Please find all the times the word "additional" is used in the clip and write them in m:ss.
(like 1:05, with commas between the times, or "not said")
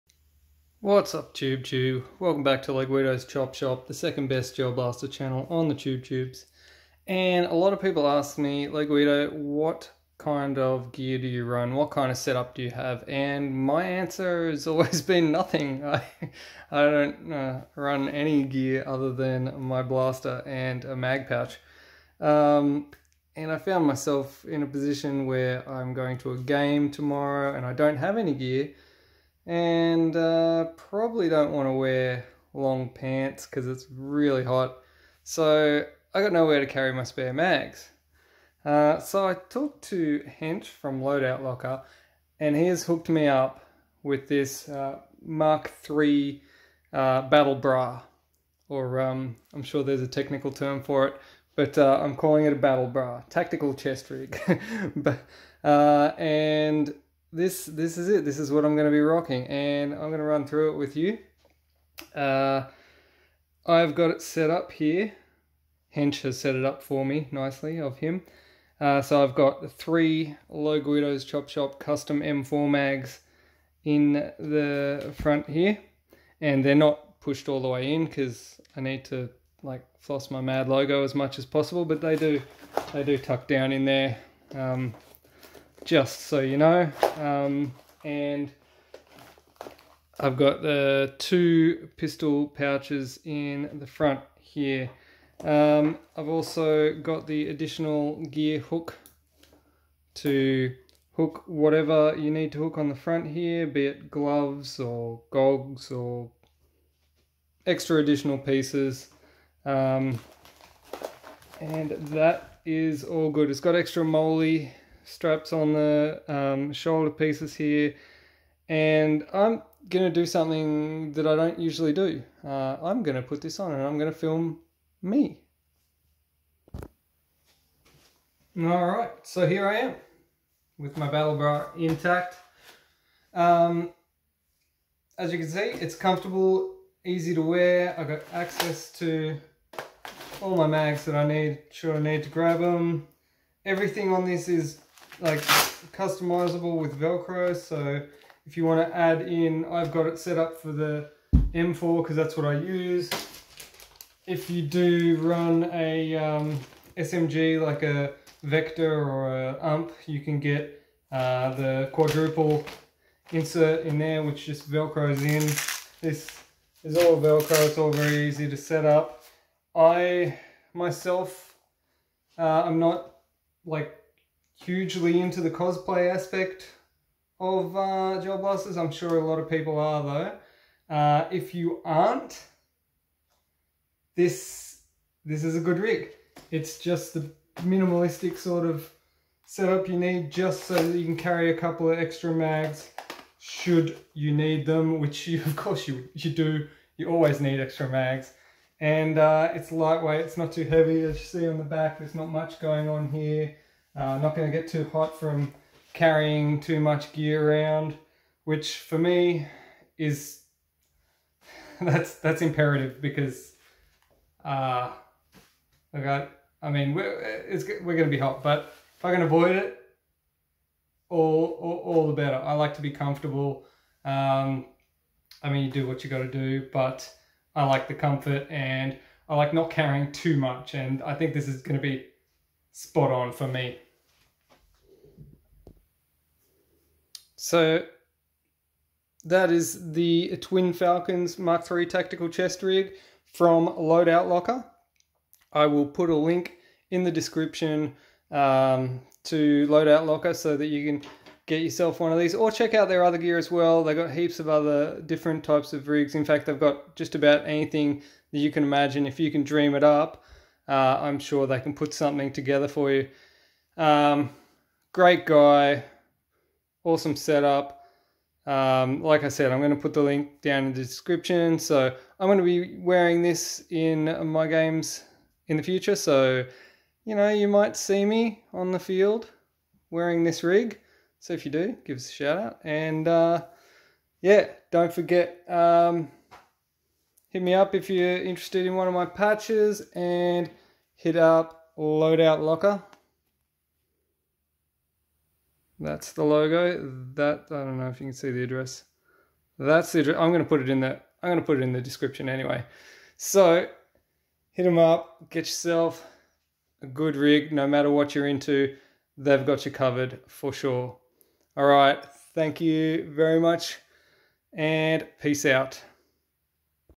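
1:37, 1:47.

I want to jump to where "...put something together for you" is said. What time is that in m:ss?
4:21.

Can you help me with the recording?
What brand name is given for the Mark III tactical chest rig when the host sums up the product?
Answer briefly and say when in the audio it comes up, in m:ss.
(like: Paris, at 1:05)
Twin Falcons, at 4:00.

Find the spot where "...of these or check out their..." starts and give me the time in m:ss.
4:12.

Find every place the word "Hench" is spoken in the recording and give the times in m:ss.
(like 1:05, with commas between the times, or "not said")
0:40, 1:05.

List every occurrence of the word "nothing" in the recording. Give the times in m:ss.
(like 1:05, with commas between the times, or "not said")
0:15.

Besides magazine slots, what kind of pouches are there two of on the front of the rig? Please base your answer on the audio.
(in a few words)
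Pistol pouches.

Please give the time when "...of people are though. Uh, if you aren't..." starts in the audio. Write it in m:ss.
2:59.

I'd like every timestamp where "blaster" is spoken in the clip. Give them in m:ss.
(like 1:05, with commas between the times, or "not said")
0:04, 0:19, 2:58.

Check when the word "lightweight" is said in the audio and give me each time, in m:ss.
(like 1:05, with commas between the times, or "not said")
3:19.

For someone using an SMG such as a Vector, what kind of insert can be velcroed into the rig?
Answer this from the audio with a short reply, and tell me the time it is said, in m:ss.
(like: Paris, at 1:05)
Quadruple insert, at 2:41.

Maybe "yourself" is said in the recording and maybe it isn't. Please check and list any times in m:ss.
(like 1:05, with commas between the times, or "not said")
4:11, 5:05.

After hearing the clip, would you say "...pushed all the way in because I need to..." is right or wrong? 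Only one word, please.
right.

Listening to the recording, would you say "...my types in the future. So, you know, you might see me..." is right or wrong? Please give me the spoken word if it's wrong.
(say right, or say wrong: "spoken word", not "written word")
wrong: "games", not "types".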